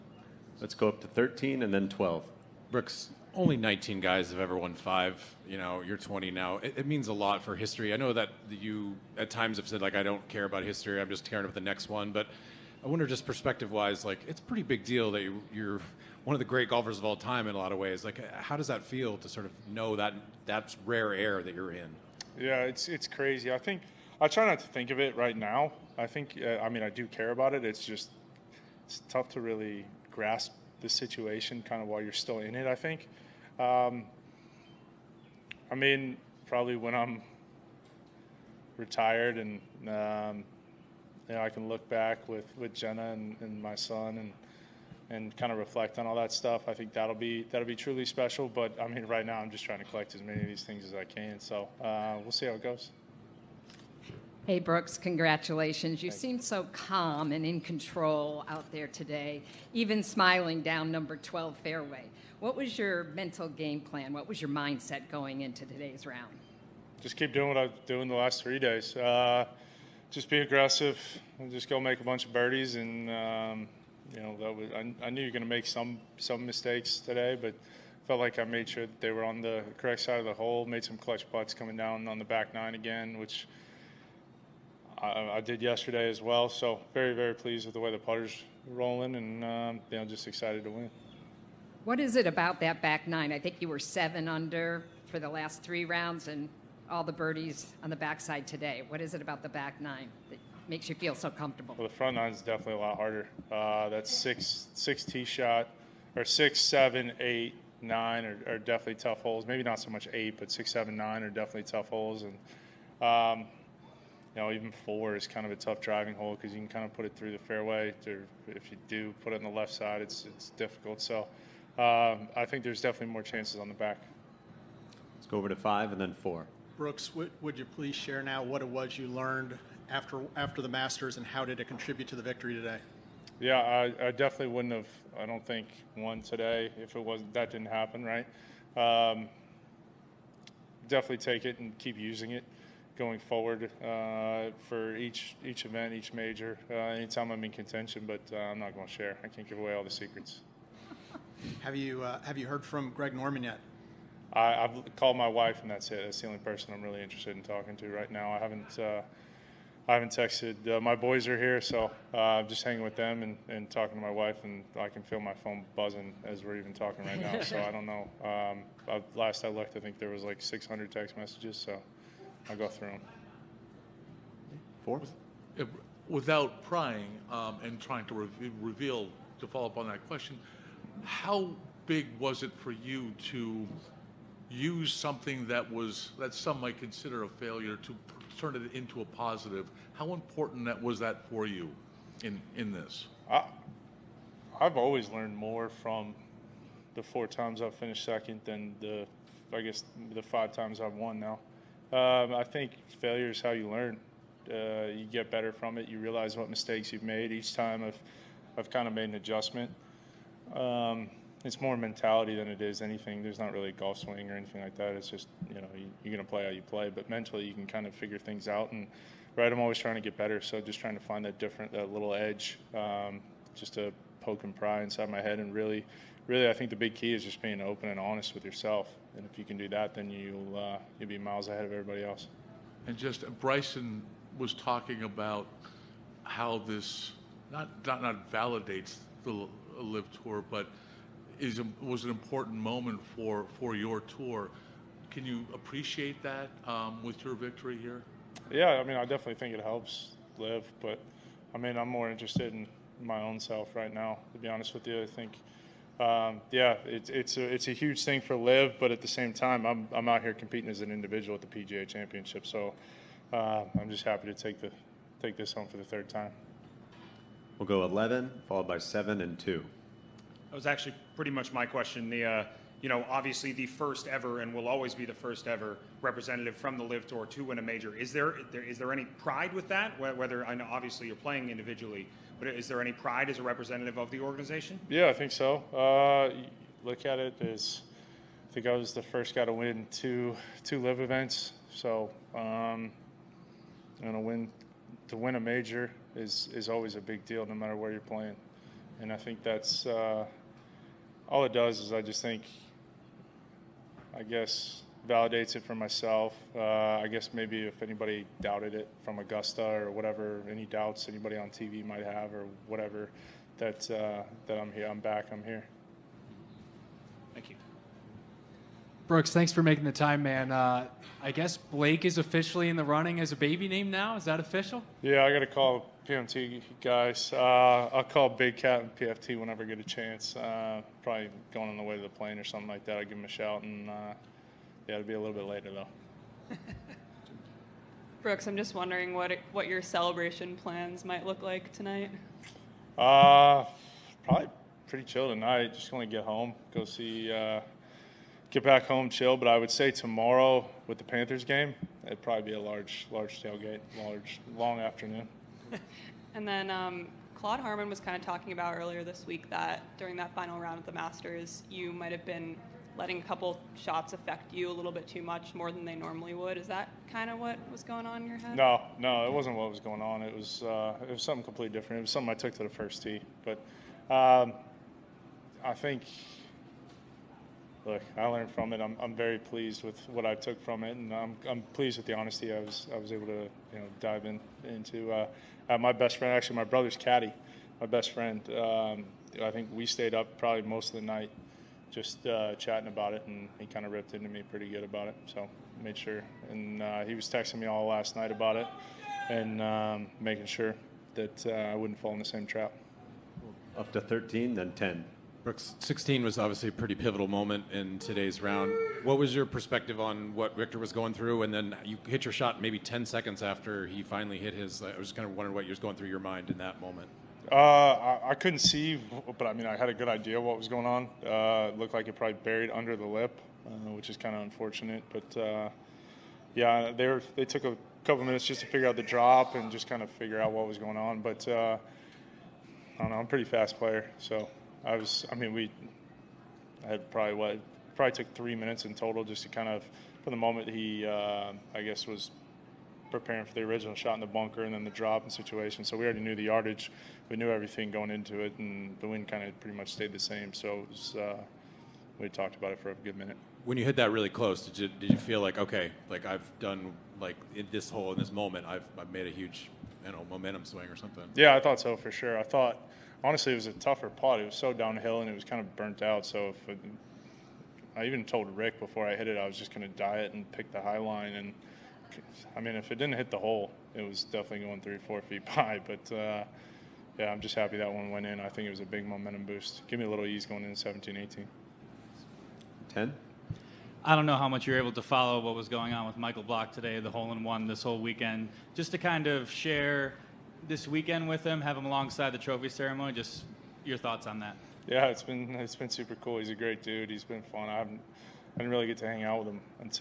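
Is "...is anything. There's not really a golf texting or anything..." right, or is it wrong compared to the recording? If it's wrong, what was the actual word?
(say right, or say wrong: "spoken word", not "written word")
wrong: "swing", not "texting".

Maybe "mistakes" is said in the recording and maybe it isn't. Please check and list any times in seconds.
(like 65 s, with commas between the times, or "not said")
76 s, 206 s.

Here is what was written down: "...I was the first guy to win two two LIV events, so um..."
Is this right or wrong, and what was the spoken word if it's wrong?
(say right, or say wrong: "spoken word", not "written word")
right.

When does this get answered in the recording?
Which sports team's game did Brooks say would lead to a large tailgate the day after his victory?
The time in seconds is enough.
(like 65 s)
351 s.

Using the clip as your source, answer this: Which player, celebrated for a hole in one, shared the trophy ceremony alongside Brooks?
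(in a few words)
Michael Block.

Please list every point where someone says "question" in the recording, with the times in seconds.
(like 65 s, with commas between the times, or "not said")
180 s, 271 s.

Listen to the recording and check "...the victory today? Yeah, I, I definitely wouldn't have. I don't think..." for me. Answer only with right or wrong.
right.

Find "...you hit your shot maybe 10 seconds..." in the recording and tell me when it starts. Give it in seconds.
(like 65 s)
411 s.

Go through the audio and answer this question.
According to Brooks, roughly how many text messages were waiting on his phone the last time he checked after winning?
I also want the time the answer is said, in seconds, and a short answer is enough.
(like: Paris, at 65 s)
600, at 170 s.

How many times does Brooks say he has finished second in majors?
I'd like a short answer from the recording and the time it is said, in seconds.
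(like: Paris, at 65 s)
4, at 197 s.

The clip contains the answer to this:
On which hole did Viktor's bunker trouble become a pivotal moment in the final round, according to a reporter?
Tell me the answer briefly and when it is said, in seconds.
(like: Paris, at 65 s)
16, at 405 s.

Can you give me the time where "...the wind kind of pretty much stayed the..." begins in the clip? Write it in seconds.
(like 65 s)
448 s.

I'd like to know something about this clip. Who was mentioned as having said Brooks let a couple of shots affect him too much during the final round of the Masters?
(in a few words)
Claude Harmon.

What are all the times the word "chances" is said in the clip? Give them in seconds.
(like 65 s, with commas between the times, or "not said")
123 s, 329 s.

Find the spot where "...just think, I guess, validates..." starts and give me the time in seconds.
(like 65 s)
302 s.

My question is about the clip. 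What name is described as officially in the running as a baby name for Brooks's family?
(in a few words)
Blake.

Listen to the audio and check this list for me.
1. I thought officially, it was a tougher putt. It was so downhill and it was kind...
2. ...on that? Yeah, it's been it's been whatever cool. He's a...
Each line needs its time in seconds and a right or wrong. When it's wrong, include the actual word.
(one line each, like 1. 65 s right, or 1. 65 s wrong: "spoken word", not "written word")
1. 462 s wrong: "honestly", not "officially"
2. 494 s wrong: "super", not "whatever".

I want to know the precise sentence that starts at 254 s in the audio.
To be honest with you, I think, um, yeah, it's it's a it's a huge thing for Liv.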